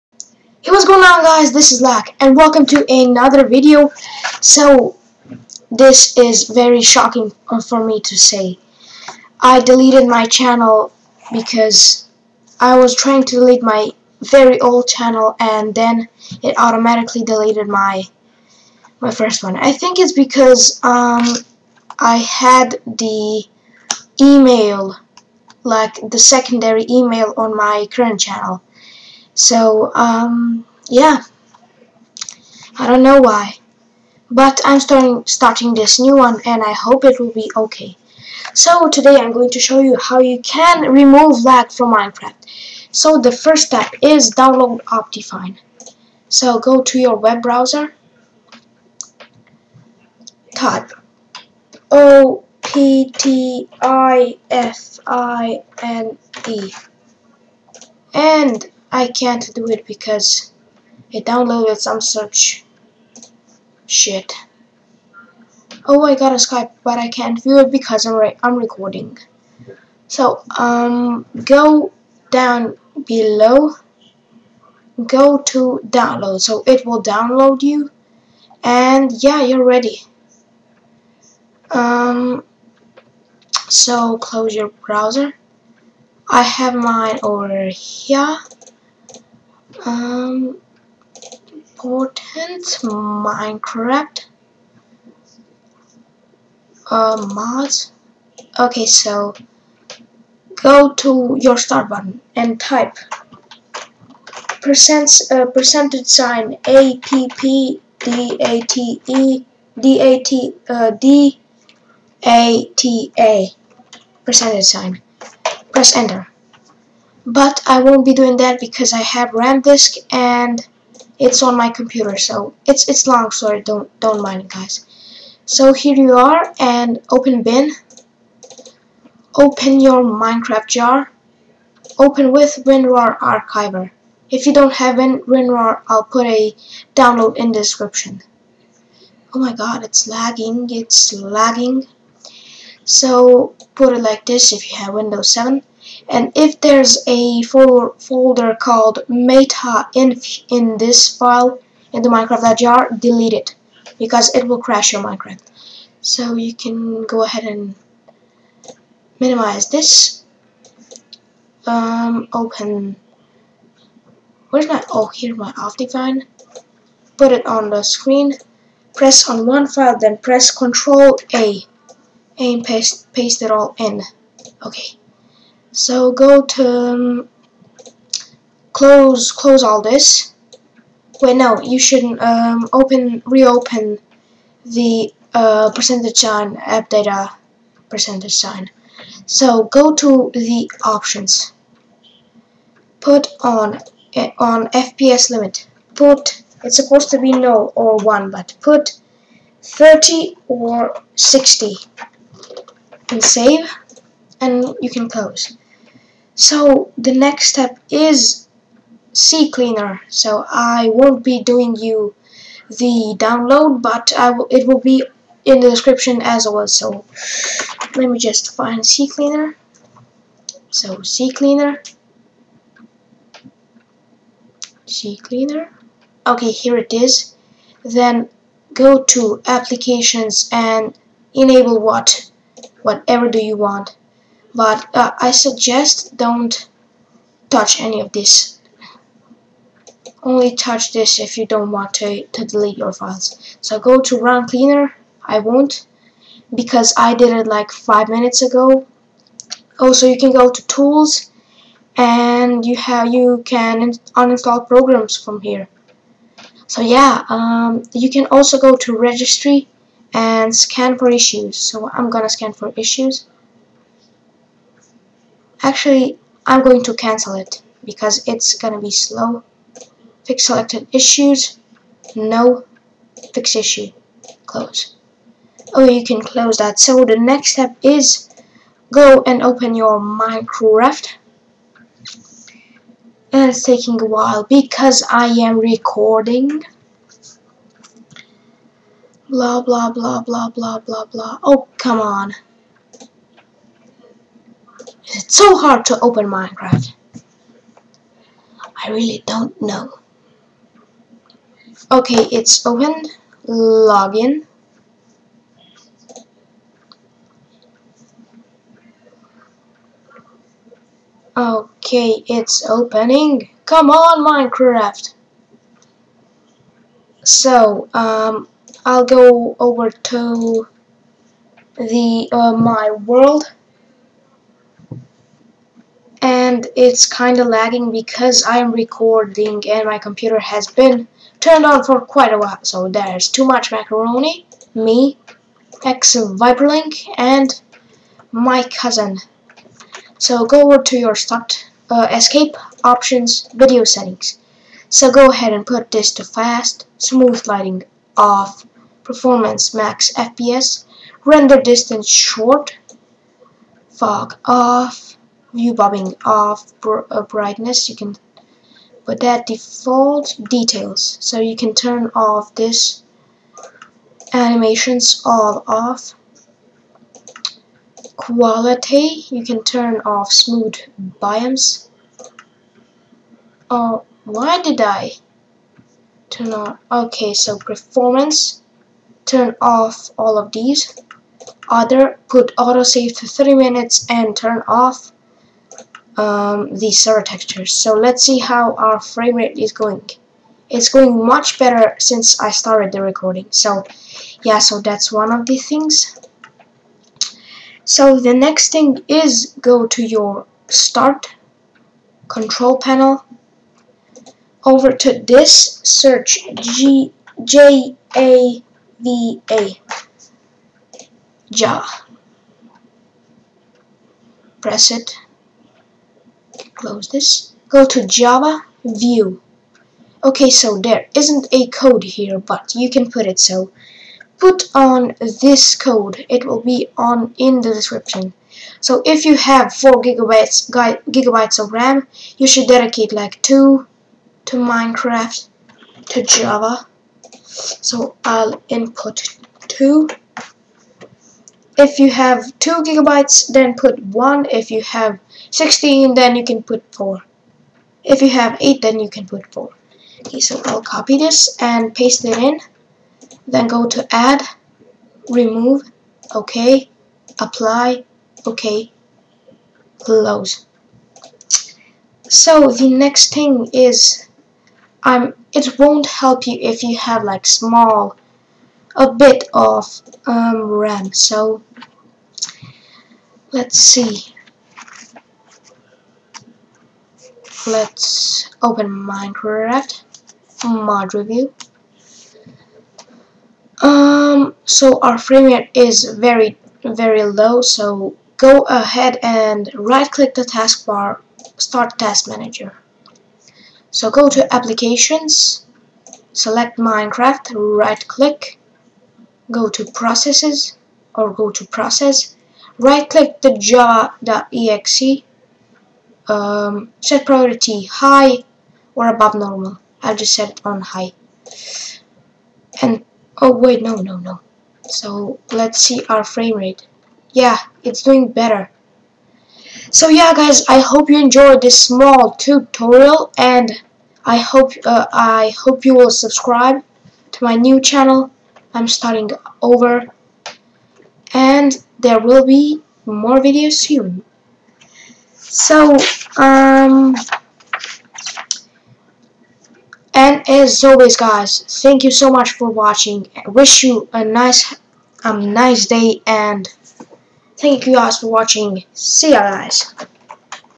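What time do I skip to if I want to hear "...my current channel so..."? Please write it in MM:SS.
00:27.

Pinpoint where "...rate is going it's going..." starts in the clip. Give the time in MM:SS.
06:29.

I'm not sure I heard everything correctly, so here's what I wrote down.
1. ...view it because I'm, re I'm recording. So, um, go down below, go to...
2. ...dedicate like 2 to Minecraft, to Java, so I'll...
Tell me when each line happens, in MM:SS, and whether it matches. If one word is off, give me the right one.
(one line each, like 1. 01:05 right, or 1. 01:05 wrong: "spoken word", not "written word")
1. 01:07 right
2. 07:12 right.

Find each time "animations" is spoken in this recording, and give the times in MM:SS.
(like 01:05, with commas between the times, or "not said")
06:04.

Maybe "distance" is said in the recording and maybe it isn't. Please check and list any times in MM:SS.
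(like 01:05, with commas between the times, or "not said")
05:51.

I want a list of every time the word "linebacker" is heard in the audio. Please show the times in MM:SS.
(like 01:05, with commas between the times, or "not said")
not said.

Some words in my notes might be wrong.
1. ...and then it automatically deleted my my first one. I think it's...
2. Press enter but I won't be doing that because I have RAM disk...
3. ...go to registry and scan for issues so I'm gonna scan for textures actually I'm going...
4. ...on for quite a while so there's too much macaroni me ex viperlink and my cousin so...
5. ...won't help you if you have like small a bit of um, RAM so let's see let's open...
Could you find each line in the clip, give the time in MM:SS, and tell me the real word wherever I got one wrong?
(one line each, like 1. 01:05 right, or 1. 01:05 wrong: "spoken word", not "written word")
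1. 00:15 right
2. 01:55 right
3. 04:18 wrong: "issues", not "textures"
4. 05:31 right
5. 07:45 right.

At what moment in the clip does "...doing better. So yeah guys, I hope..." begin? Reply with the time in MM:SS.
08:38.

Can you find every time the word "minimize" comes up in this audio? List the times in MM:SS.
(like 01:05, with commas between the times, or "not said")
02:39.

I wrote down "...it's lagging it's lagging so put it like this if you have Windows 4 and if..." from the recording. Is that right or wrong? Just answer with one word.
wrong.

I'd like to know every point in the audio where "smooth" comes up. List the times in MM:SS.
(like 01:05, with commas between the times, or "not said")
05:46, 06:10.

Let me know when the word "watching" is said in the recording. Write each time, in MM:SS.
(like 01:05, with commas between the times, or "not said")
09:02, 09:08.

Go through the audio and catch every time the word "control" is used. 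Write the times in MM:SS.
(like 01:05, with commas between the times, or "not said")
02:50, 06:42.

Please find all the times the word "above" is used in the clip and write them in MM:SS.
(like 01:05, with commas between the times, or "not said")
08:29.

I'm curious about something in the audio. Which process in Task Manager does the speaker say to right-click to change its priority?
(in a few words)
Java.exe.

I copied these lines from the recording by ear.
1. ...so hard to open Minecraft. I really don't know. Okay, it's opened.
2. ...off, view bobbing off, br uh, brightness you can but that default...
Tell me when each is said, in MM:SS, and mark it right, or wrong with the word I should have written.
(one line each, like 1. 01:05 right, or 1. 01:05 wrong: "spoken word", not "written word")
1. 04:55 right
2. 05:54 right.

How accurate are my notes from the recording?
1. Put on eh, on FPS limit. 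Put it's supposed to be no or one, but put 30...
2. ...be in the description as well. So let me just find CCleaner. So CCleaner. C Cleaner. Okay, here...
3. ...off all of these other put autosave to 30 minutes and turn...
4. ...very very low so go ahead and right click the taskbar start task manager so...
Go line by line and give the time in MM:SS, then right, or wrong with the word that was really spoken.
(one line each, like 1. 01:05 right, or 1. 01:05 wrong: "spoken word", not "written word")
1. 03:13 right
2. 03:34 right
3. 06:19 right
4. 08:06 right.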